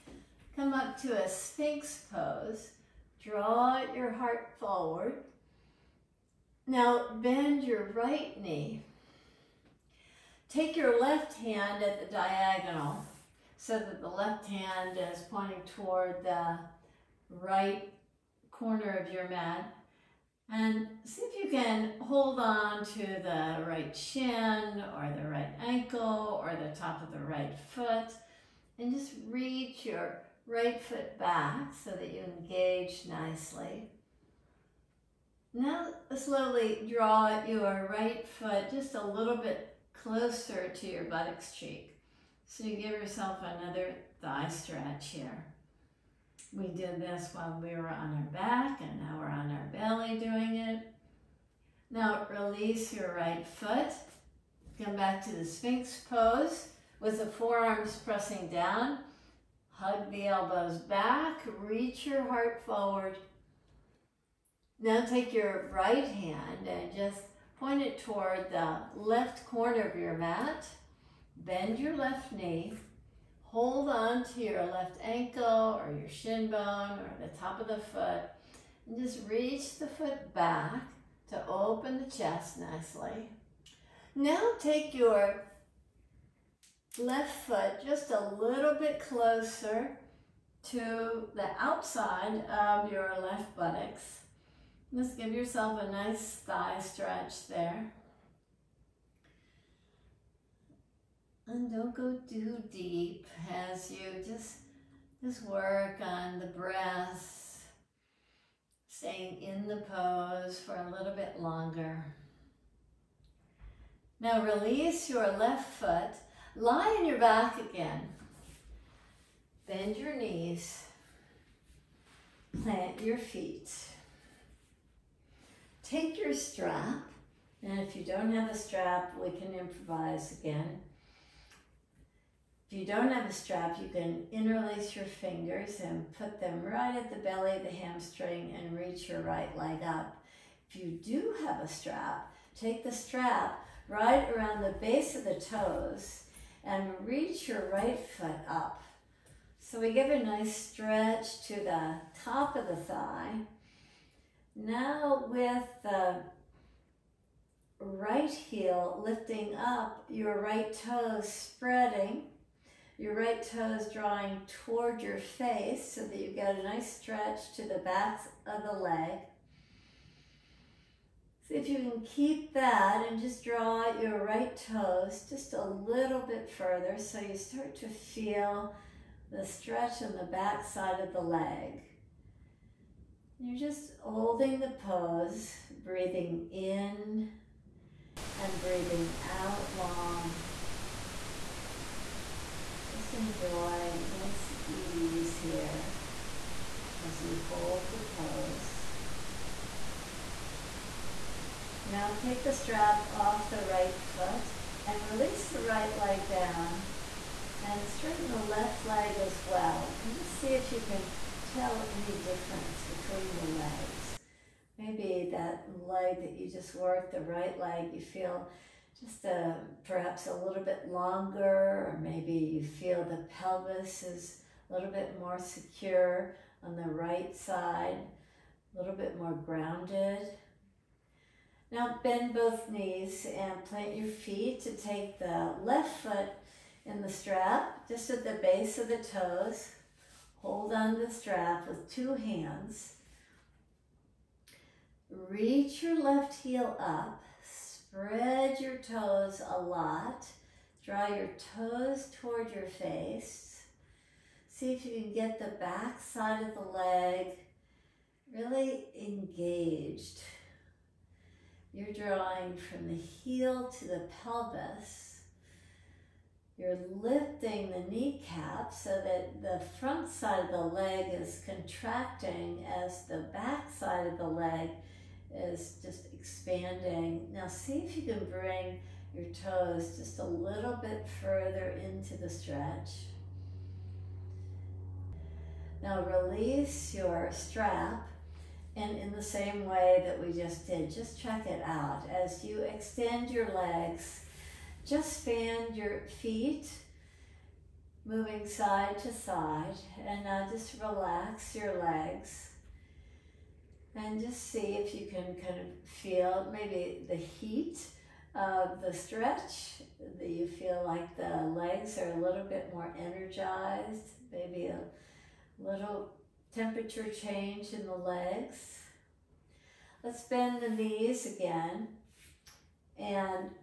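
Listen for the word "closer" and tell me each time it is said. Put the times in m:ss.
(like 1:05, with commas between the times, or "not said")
0:40, 1:28.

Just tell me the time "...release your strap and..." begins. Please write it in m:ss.
4:46.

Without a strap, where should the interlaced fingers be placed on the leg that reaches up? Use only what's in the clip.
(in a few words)
belly of the hamstring.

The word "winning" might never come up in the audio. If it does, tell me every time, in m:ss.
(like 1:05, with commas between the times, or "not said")
not said.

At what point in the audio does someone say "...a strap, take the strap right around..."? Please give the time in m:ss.
2:21.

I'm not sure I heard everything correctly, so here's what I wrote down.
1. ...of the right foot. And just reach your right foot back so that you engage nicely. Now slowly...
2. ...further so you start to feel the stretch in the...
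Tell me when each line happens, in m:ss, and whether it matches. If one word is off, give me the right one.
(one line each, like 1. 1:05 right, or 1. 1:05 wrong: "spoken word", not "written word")
1. 0:27 right
2. 2:56 right.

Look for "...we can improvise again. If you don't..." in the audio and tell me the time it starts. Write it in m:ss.
2:09.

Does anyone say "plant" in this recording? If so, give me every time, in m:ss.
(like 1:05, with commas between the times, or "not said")
2:02, 3:53.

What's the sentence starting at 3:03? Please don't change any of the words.
You're just holding the pose, breathing in and breathing out long.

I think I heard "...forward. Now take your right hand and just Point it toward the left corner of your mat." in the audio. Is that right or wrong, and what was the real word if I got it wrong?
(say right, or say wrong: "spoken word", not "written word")
right.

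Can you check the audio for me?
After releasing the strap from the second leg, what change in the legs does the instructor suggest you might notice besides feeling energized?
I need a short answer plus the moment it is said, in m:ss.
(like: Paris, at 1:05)
temperature change, at 5:16.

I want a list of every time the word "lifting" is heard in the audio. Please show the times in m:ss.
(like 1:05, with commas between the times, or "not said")
2:39, 4:27.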